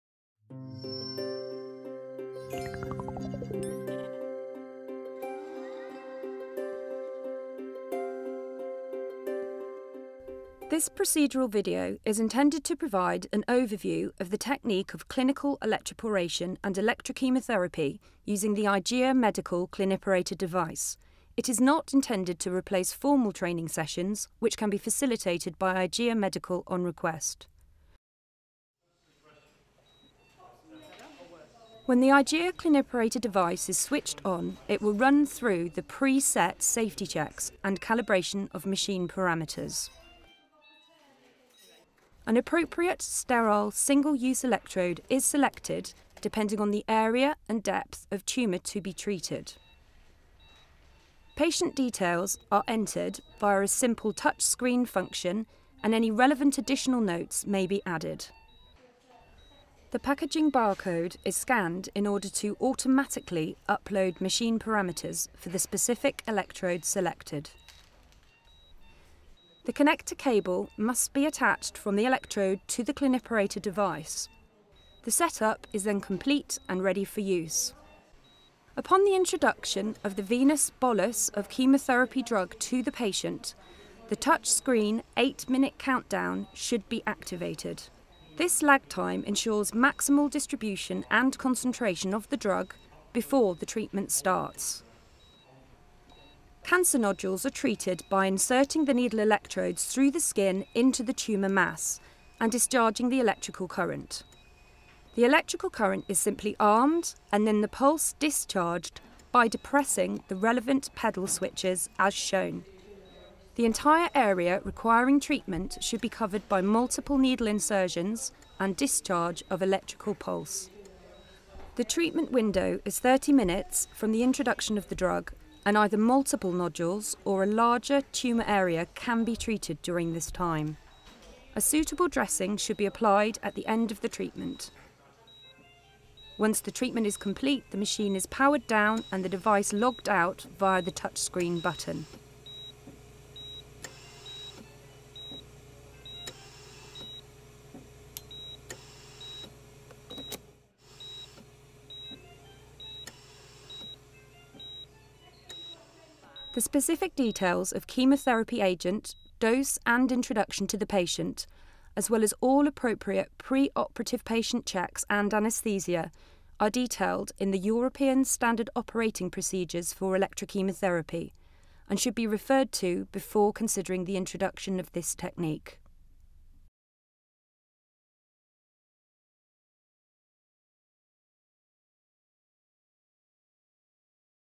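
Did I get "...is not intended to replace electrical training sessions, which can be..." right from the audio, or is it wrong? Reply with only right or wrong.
wrong.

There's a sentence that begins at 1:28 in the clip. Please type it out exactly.
This lag time ensures maximal distribution and concentration of the drug before the treatment starts.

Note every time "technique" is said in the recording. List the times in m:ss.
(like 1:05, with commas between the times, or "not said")
0:14, 2:55.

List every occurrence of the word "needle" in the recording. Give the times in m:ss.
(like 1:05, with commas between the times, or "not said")
1:38, 1:57.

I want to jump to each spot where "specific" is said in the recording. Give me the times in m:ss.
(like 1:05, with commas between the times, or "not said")
1:05, 2:36.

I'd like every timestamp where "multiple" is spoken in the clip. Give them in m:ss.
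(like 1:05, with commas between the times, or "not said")
1:56, 2:05.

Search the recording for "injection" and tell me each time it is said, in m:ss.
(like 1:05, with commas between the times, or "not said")
not said.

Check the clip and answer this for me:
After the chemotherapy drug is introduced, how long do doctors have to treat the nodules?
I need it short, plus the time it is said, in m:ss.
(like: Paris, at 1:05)
30 minutes, at 2:02.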